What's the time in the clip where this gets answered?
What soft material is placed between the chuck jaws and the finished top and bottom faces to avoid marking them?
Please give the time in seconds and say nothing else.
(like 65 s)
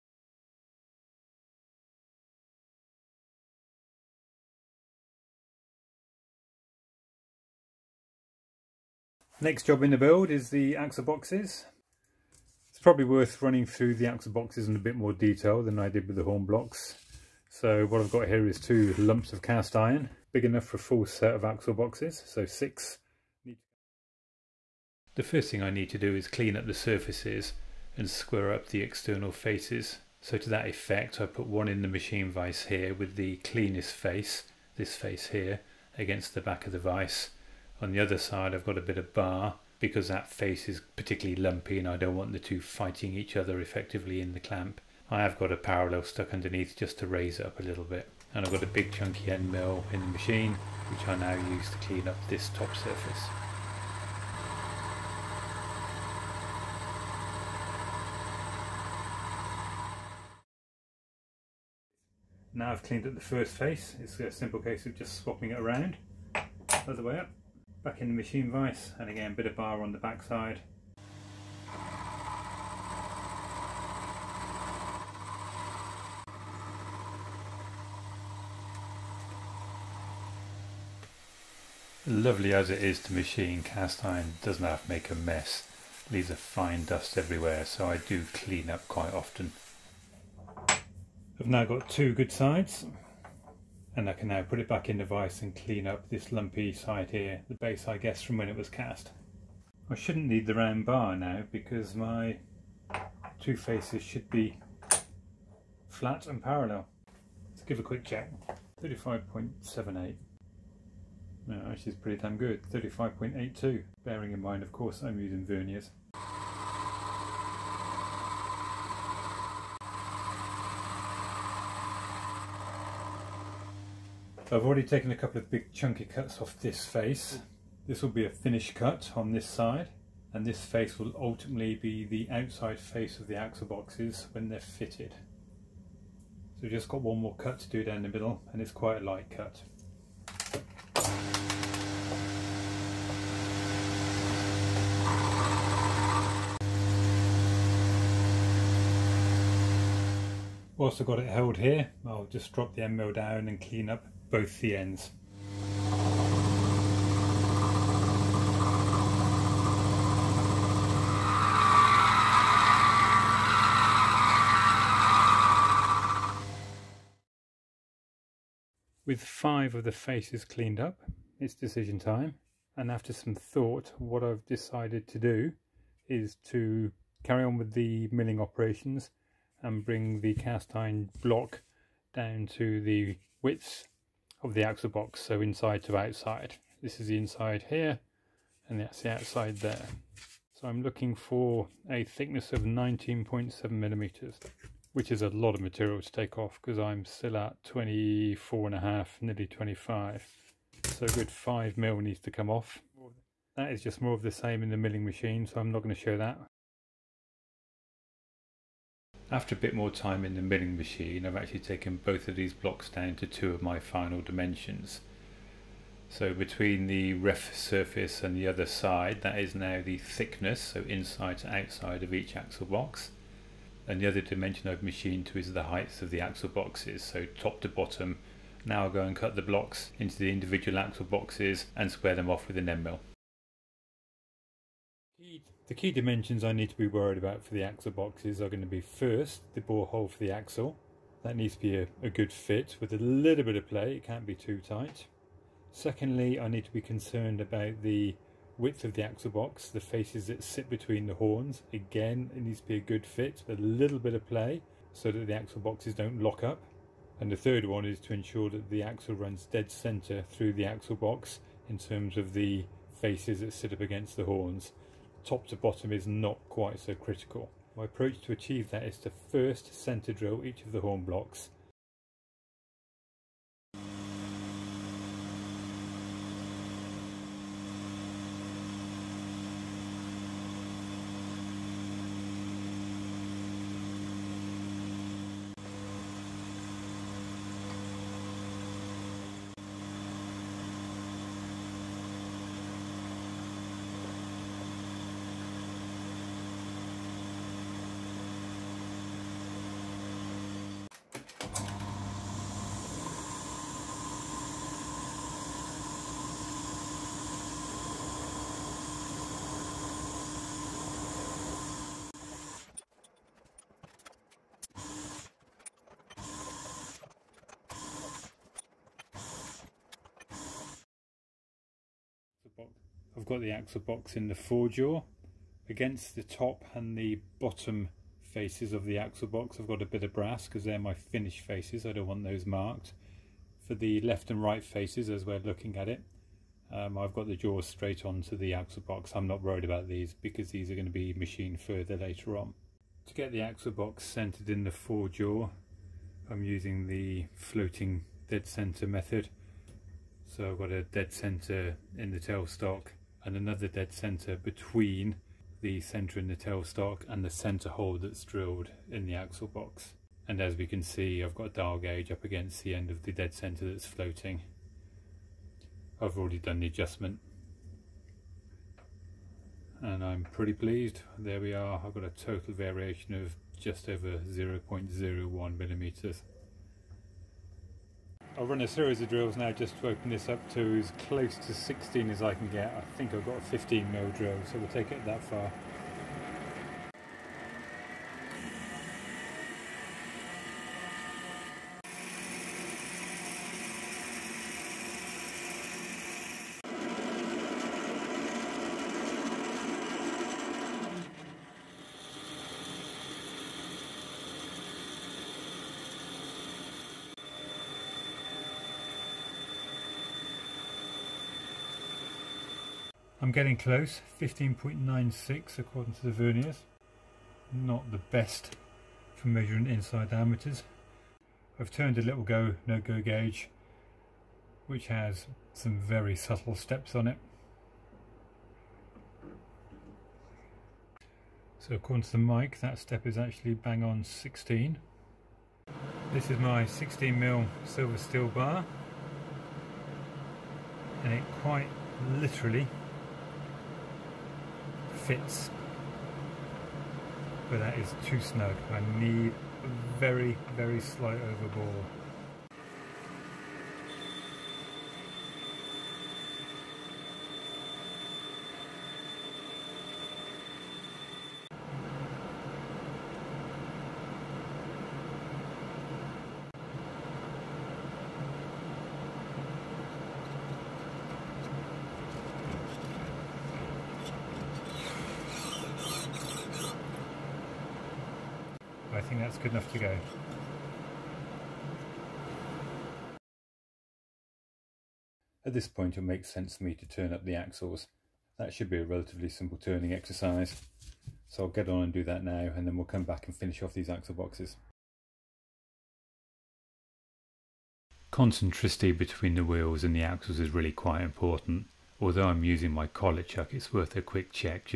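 330 s.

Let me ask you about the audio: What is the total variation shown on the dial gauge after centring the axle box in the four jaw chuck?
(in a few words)
just over 0.01 mm.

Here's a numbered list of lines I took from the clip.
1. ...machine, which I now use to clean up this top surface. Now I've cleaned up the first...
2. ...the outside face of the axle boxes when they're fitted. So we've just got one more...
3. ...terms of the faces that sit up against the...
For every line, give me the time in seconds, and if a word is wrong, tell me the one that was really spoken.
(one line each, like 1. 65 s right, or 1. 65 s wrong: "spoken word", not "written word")
1. 50 s right
2. 132 s right
3. 261 s right.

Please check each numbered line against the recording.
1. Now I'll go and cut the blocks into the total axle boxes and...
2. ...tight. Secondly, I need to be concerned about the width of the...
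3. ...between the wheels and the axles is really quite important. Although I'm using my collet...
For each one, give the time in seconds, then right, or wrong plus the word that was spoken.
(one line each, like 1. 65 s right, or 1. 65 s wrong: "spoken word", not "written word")
1. 228 s wrong: "individual", not "total"
2. 244 s right
3. 498 s right.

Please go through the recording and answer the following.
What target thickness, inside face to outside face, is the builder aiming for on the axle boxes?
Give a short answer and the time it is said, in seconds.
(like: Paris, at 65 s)
19.7 mm, at 192 s.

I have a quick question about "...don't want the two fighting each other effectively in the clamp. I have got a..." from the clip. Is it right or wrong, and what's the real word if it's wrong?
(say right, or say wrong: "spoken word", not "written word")
right.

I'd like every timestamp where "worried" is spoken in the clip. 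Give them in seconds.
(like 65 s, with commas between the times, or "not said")
236 s, 339 s.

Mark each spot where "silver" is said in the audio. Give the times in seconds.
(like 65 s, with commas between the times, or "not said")
437 s.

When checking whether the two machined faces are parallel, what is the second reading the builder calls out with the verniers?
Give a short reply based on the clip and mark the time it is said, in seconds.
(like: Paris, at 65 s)
35.82, at 112 s.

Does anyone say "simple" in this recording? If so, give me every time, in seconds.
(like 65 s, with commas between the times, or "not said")
64 s, 489 s.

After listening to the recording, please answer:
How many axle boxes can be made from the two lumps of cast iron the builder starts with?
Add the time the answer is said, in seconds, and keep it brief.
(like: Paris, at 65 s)
6, at 22 s.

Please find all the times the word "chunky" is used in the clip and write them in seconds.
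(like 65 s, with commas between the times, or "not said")
48 s, 125 s.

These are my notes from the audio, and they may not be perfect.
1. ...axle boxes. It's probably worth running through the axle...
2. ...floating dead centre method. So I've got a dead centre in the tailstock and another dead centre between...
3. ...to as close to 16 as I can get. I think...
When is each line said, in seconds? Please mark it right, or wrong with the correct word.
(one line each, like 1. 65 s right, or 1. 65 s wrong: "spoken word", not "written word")
1. 10 s right
2. 347 s right
3. 380 s right.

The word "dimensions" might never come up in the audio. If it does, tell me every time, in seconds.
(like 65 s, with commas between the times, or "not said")
214 s, 224 s, 235 s.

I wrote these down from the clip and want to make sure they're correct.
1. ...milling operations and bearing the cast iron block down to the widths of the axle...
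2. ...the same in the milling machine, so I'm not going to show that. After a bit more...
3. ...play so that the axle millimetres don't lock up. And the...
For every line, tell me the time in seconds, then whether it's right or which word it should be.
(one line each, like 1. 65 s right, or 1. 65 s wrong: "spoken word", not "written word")
1. 178 s wrong: "bring", not "bearing"
2. 204 s right
3. 254 s wrong: "boxes", not "millimetres".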